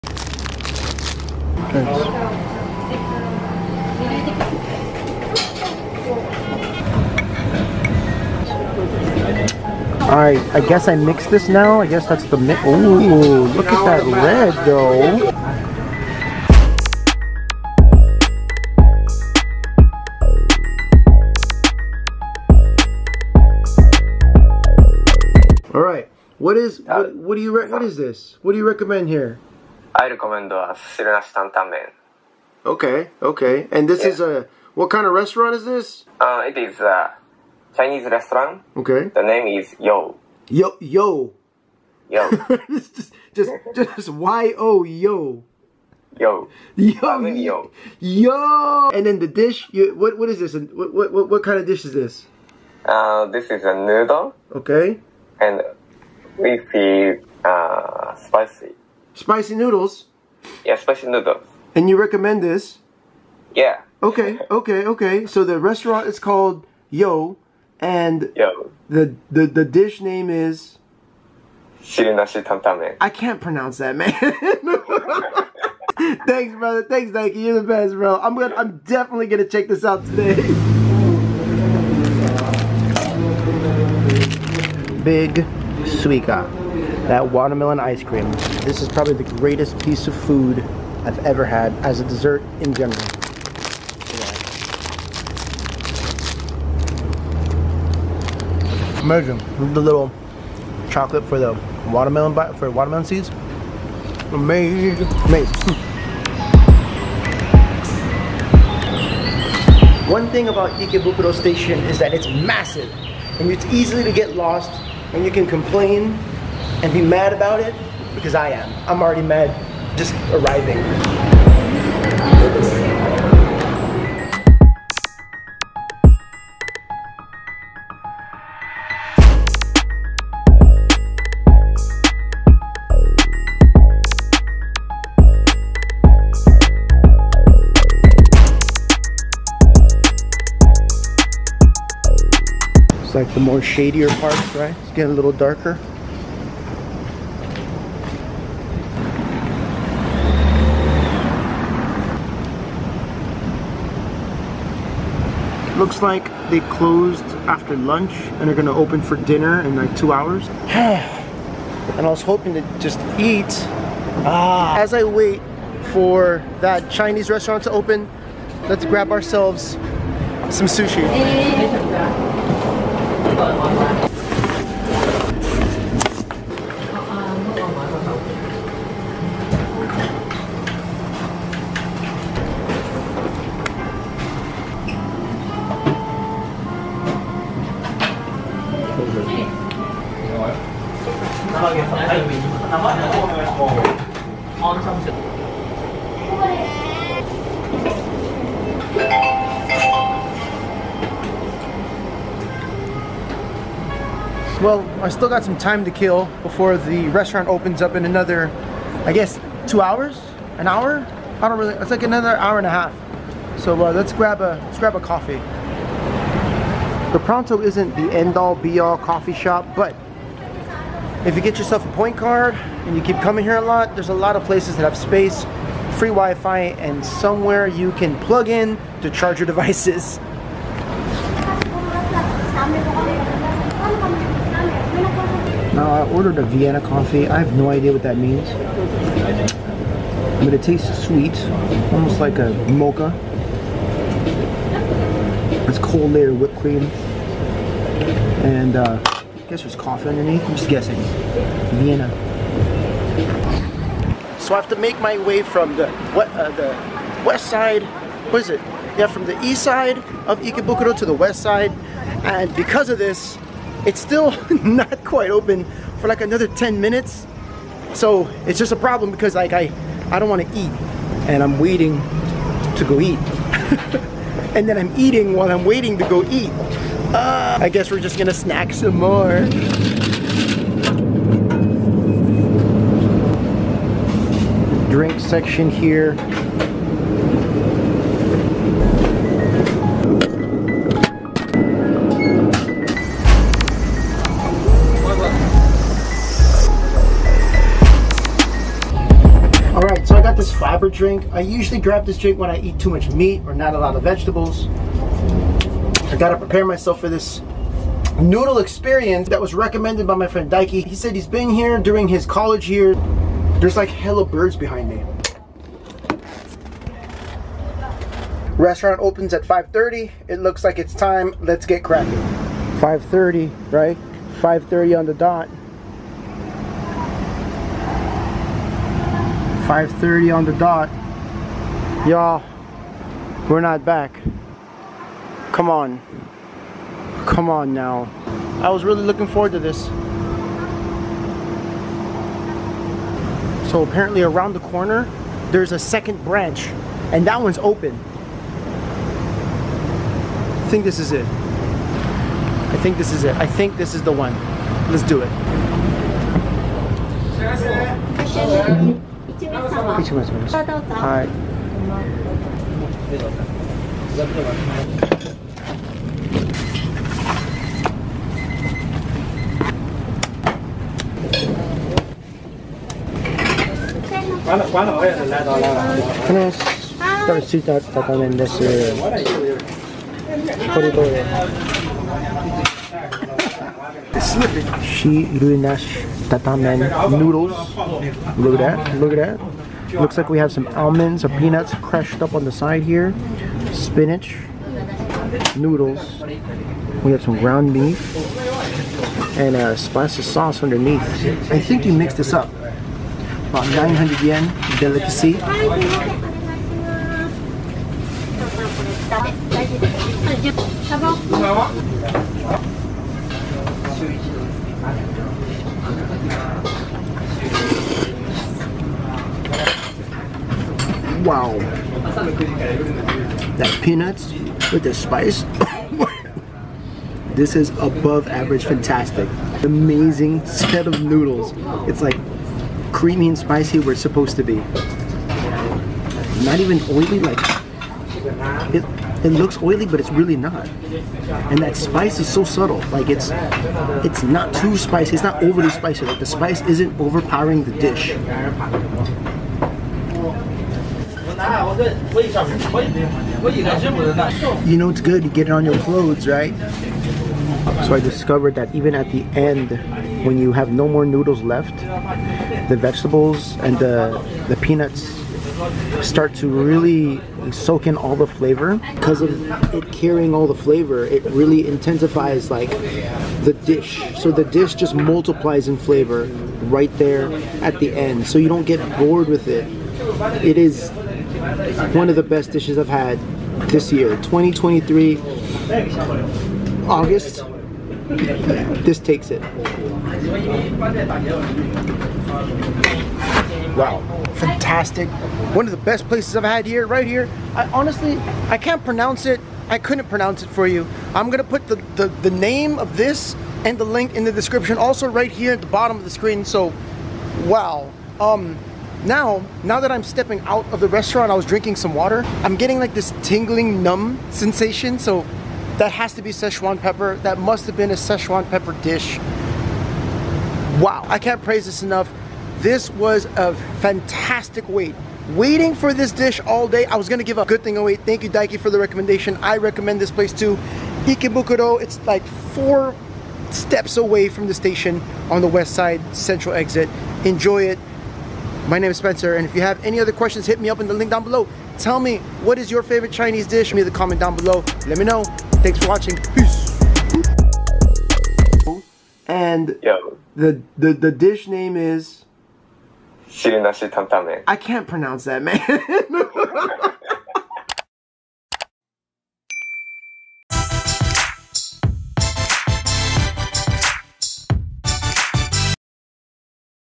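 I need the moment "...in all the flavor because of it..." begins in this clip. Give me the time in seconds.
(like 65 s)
467 s.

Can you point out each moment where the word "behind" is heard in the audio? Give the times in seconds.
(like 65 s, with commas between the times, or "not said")
314 s.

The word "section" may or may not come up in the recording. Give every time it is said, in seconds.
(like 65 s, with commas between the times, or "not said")
285 s.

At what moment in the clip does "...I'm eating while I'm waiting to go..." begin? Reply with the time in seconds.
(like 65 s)
274 s.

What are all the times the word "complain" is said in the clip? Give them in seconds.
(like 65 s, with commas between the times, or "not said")
115 s.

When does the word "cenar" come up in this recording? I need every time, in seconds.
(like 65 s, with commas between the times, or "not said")
375 s.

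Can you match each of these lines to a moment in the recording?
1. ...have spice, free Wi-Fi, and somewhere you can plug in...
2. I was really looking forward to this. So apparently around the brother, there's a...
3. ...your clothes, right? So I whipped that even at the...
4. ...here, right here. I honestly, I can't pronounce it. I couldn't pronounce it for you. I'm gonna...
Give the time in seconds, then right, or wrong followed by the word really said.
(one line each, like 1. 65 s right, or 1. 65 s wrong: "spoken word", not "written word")
1. 224 s wrong: "space", not "spice"
2. 338 s wrong: "corner", not "brother"
3. 455 s wrong: "discovered", not "whipped"
4. 496 s right.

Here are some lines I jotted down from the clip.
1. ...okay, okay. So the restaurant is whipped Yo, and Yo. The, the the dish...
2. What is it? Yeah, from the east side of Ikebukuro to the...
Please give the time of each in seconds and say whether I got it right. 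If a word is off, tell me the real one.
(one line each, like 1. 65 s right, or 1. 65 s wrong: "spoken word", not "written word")
1. 64 s wrong: "called", not "whipped"
2. 258 s right.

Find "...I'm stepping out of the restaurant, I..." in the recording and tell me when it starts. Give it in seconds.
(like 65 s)
509 s.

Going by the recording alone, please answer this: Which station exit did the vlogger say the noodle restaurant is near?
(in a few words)
West side central exit.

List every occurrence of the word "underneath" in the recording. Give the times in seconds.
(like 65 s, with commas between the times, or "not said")
250 s, 400 s.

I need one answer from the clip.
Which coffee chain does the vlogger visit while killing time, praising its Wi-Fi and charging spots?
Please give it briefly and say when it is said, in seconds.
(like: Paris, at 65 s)
Pronto, at 217 s.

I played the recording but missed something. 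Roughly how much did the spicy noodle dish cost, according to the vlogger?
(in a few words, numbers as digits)
900 yen.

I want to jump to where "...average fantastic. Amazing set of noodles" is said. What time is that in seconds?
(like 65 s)
428 s.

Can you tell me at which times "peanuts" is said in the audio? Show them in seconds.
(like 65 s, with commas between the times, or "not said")
391 s, 423 s, 464 s.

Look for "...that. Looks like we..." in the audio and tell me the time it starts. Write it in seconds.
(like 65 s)
389 s.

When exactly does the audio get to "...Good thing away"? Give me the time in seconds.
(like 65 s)
527 s.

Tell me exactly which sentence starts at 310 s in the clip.
He said he's been here during his college year.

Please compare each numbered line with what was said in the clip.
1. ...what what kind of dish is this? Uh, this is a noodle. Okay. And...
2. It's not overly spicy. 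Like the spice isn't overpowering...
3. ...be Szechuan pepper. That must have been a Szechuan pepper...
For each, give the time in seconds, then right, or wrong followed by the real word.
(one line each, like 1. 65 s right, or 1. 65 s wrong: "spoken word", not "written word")
1. 51 s right
2. 445 s right
3. 516 s right.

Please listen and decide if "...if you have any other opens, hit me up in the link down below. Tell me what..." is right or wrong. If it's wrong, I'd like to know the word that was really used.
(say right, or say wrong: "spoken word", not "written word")
wrong: "questions", not "opens".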